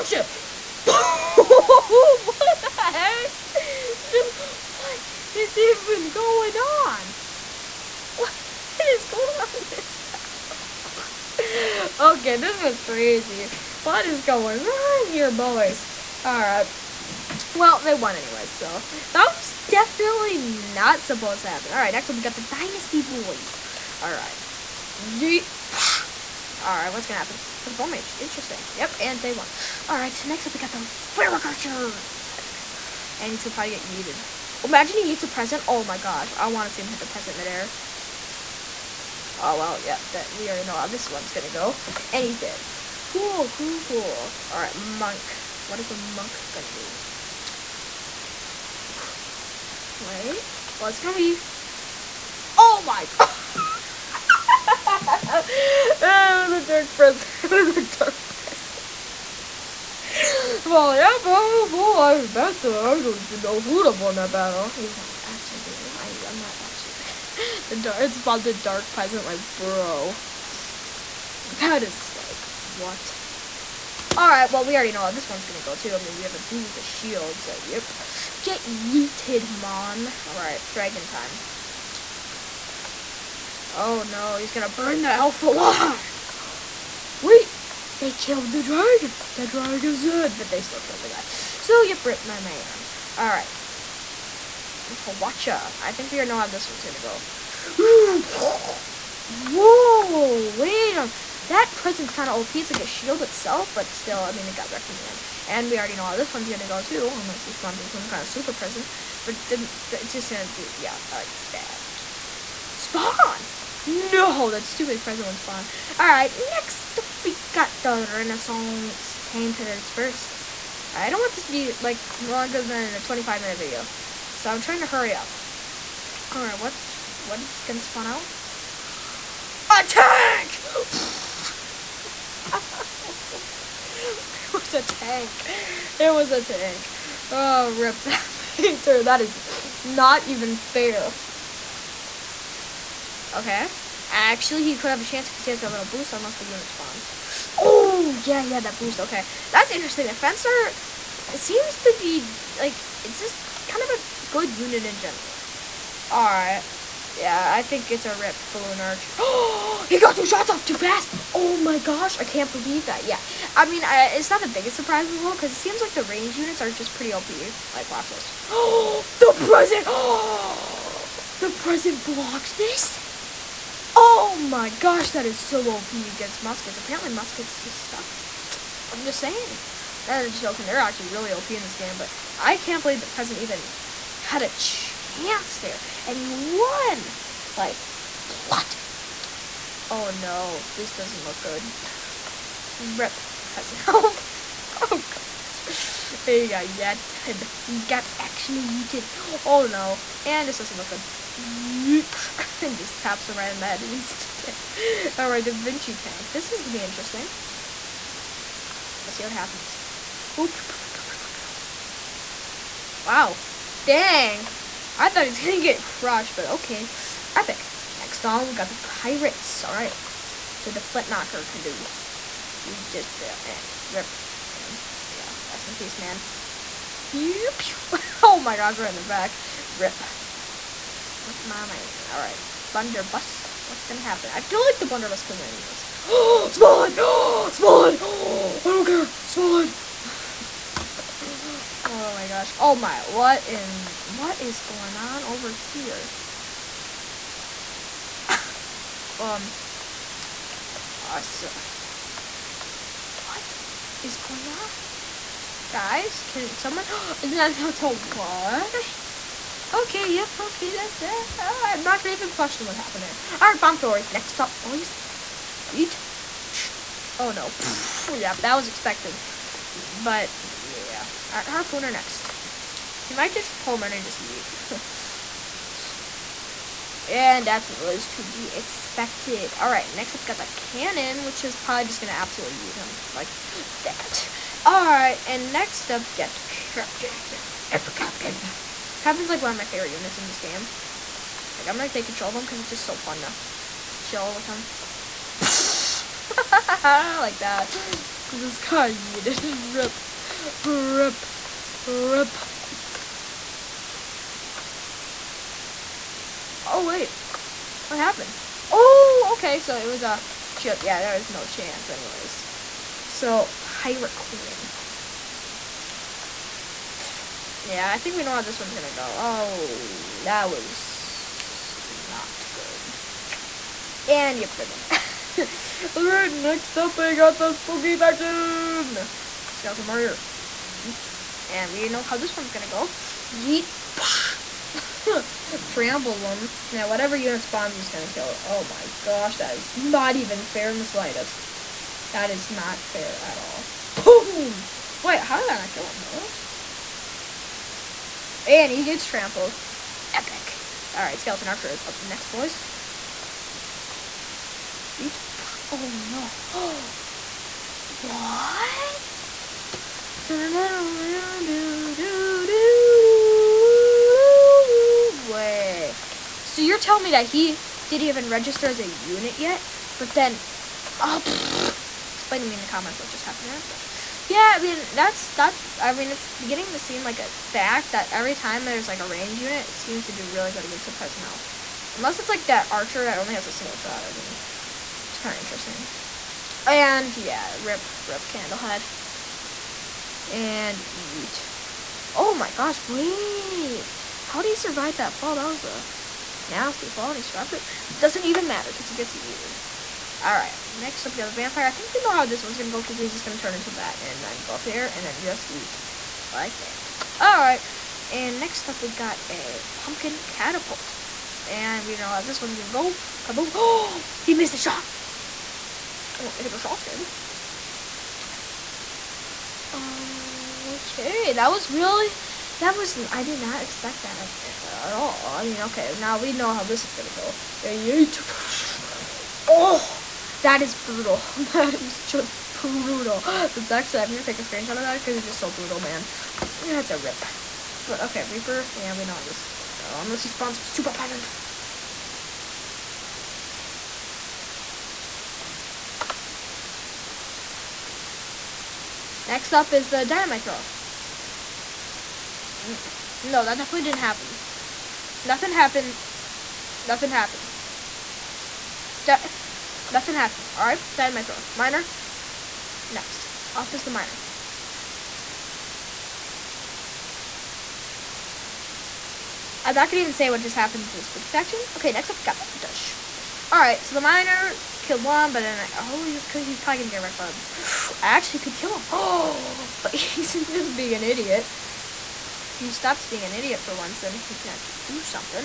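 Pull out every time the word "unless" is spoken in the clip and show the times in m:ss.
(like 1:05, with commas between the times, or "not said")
1:47, 2:26, 6:21, 7:20.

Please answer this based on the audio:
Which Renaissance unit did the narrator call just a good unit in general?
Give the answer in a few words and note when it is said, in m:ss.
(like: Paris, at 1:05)
The Fencer, at 2:30.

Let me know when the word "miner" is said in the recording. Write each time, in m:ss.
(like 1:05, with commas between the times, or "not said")
7:53.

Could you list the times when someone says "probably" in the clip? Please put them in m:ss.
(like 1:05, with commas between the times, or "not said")
0:33, 4:41, 7:56.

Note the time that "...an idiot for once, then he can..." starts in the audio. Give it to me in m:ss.
8:03.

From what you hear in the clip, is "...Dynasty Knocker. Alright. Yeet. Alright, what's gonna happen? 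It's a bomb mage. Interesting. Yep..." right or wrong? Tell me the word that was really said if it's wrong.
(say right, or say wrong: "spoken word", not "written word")
wrong: "Boys", not "Knocker".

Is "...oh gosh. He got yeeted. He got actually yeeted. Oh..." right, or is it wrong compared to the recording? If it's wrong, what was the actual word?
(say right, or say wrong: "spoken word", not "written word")
right.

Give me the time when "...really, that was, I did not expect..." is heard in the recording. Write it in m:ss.
7:01.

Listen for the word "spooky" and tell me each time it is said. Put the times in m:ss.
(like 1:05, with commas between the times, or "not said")
5:27, 7:51.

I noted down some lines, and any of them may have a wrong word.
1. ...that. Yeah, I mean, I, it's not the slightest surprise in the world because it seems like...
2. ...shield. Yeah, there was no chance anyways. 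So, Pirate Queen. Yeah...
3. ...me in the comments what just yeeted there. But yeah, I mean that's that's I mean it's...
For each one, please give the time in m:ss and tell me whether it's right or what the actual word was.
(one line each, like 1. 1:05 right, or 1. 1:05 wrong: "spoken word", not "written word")
1. 2:42 wrong: "biggest", not "slightest"
2. 5:10 right
3. 6:12 wrong: "happened", not "yeeted".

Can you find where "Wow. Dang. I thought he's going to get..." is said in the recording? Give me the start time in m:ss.
3:33.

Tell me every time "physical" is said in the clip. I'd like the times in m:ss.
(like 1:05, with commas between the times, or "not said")
not said.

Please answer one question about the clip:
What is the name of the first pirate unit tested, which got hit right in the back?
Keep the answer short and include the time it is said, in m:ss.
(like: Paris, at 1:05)
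Flint Knocker, at 3:40.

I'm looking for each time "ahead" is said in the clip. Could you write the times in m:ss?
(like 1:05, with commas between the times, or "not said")
not said.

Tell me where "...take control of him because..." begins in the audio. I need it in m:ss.
4:51.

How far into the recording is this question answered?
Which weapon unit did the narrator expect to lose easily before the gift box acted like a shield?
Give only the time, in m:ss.
1:35.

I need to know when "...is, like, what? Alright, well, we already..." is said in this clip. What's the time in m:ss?
1:11.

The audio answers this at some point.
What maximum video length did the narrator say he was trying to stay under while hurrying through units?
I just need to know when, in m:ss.
2:03.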